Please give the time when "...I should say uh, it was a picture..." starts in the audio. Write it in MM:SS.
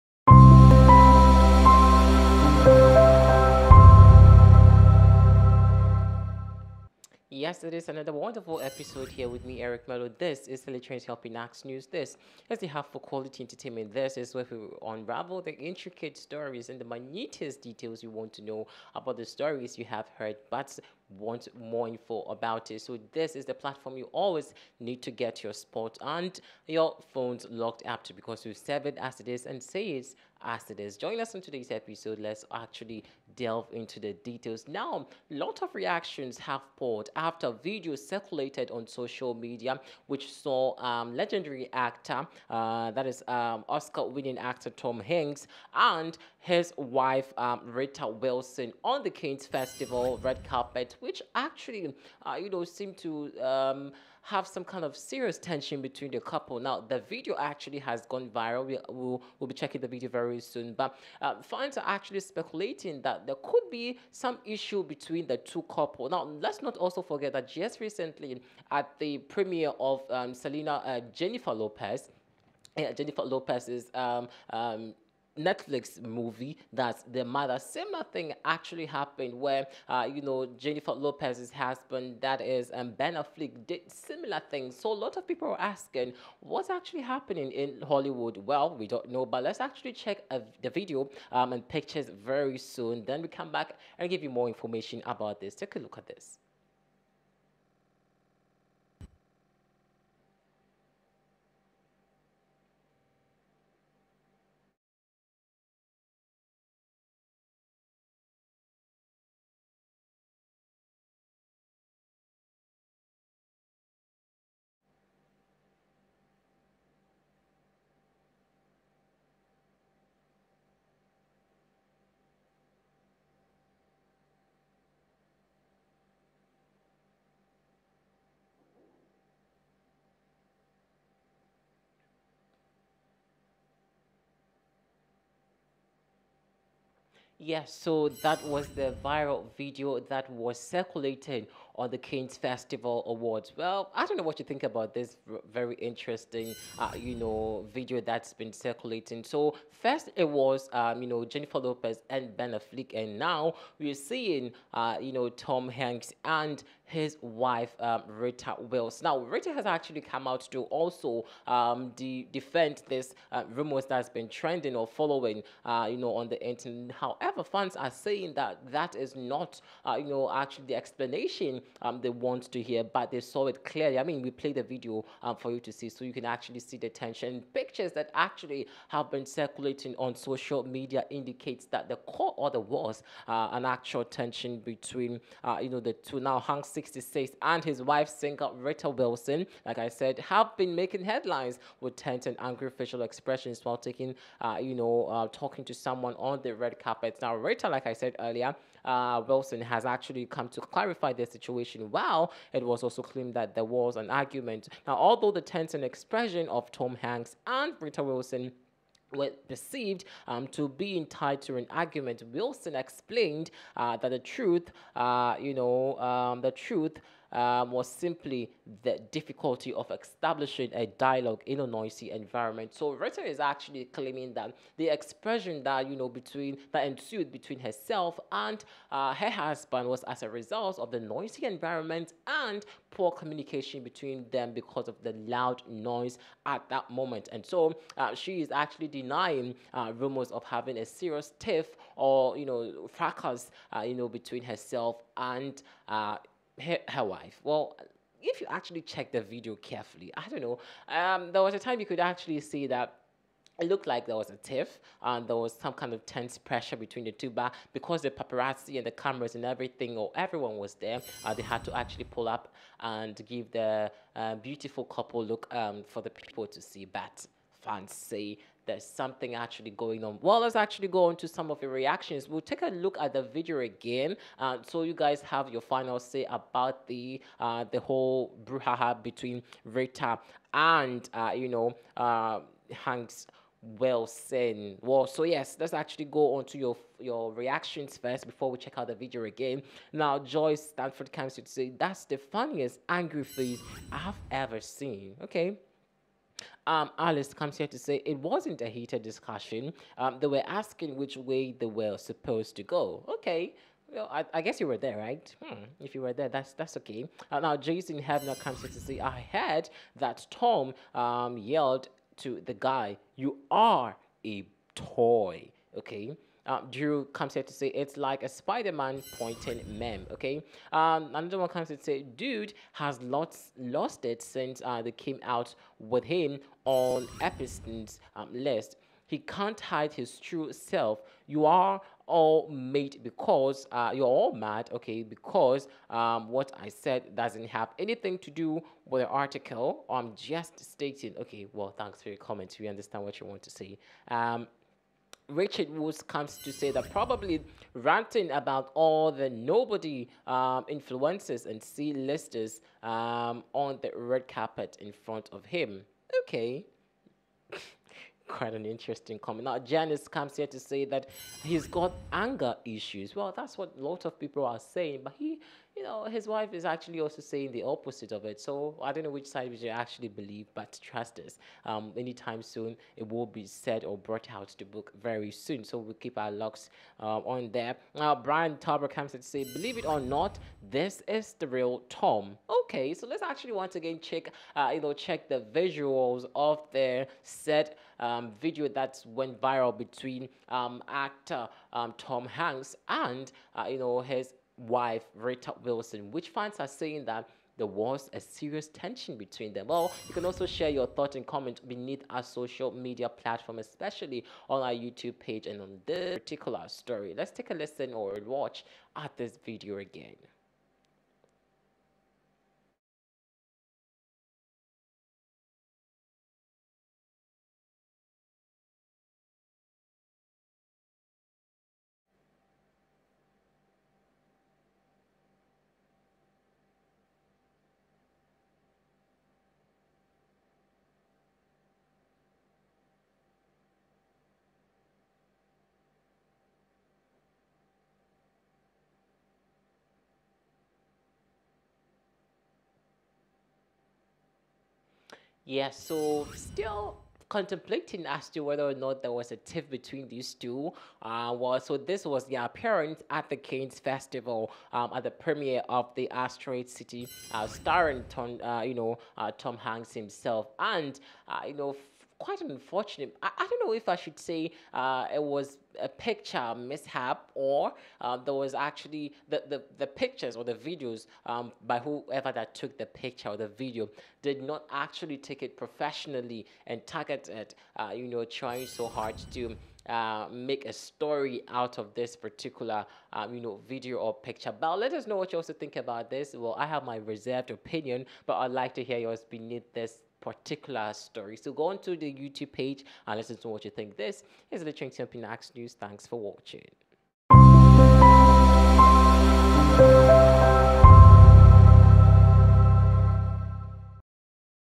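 07:43.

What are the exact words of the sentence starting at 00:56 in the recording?
Now, the video actually has gone viral.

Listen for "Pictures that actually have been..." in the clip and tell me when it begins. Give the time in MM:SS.
02:57.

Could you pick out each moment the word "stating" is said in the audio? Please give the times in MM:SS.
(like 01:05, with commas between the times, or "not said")
05:40.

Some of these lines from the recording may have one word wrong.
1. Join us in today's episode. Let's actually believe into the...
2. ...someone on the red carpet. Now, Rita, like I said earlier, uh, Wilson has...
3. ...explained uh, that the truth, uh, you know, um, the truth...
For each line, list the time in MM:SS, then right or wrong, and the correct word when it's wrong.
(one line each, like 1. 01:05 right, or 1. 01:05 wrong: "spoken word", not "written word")
1. 00:30 wrong: "delve", not "believe"
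2. 03:15 right
3. 03:32 right.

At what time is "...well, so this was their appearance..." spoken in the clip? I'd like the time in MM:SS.
07:31.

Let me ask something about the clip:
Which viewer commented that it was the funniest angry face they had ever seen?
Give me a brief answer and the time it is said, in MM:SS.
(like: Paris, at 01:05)
Joyce Stanford, at 04:50.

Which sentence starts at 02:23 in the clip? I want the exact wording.
Well, I don't know what you think about this very interesting, uh, you know, video that's been circulating.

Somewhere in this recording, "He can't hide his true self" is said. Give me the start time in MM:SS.
05:29.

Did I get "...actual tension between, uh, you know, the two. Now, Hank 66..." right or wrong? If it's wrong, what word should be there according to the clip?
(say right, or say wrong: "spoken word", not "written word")
right.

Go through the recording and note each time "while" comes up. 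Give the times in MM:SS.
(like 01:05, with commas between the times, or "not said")
03:13, 03:21.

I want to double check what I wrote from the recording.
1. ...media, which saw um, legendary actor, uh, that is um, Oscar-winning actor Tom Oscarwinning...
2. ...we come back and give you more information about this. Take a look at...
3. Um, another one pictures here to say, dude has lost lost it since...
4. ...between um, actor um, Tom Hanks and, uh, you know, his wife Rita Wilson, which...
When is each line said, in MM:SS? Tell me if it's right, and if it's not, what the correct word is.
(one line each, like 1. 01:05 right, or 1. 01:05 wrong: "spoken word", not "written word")
1. 00:39 wrong: "Hanks", not "Oscarwinning"
2. 01:33 right
3. 05:20 wrong: "comes", not "pictures"
4. 06:29 right.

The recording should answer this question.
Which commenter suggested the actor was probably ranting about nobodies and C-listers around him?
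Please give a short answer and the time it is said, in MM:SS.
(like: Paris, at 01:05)
Richard Woods, at 05:45.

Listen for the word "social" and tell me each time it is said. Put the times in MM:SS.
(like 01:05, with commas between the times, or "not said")
00:38, 03:00, 06:42.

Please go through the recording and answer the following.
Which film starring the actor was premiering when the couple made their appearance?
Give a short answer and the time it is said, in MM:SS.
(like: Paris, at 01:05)
Asteroid City, at 07:36.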